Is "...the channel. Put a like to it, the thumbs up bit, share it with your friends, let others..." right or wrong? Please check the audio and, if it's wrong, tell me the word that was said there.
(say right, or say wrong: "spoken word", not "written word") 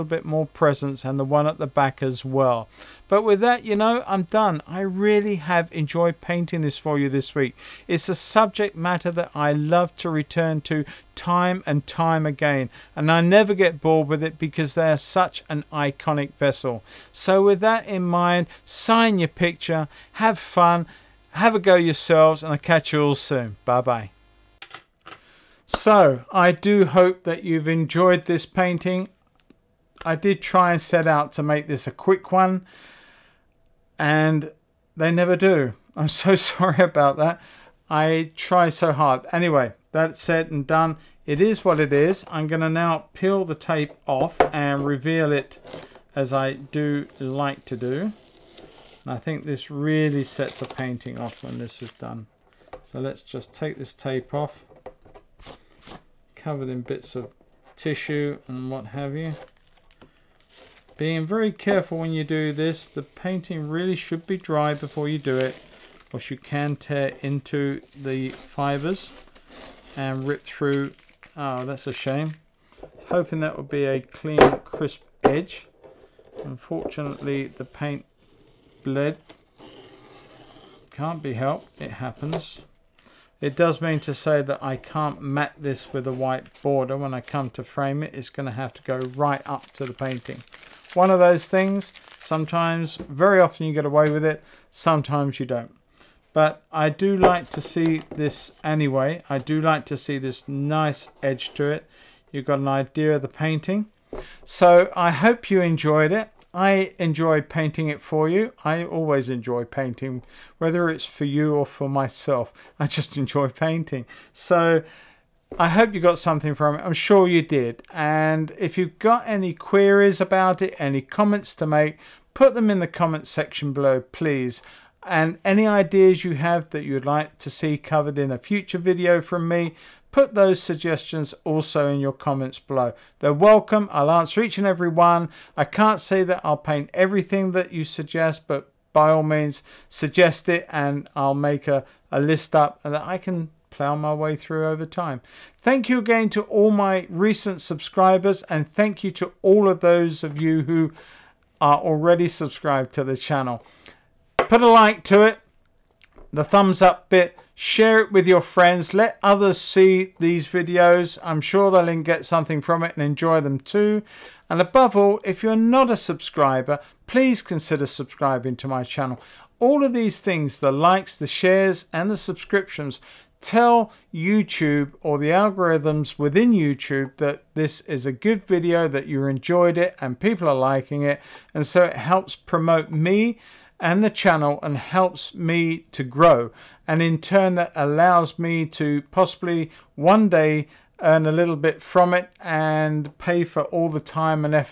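right.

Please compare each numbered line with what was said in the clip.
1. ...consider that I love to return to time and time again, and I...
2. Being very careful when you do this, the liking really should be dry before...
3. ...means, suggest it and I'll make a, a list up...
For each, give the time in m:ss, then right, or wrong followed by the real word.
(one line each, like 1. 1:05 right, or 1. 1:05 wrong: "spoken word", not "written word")
1. 0:08 wrong: "matter", not "consider"
2. 1:00 wrong: "painting", not "liking"
3. 2:19 right.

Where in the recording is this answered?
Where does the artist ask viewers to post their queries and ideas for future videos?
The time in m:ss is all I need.
2:02.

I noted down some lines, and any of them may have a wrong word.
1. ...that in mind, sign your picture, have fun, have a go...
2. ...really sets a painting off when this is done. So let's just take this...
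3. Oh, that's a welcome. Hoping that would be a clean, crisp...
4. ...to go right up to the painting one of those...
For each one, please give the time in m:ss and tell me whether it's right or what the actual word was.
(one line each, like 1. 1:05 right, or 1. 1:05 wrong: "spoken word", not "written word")
1. 0:17 right
2. 0:49 right
3. 1:11 wrong: "shame", not "welcome"
4. 1:28 right.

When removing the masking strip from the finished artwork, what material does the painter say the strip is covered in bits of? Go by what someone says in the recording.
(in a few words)
tissue.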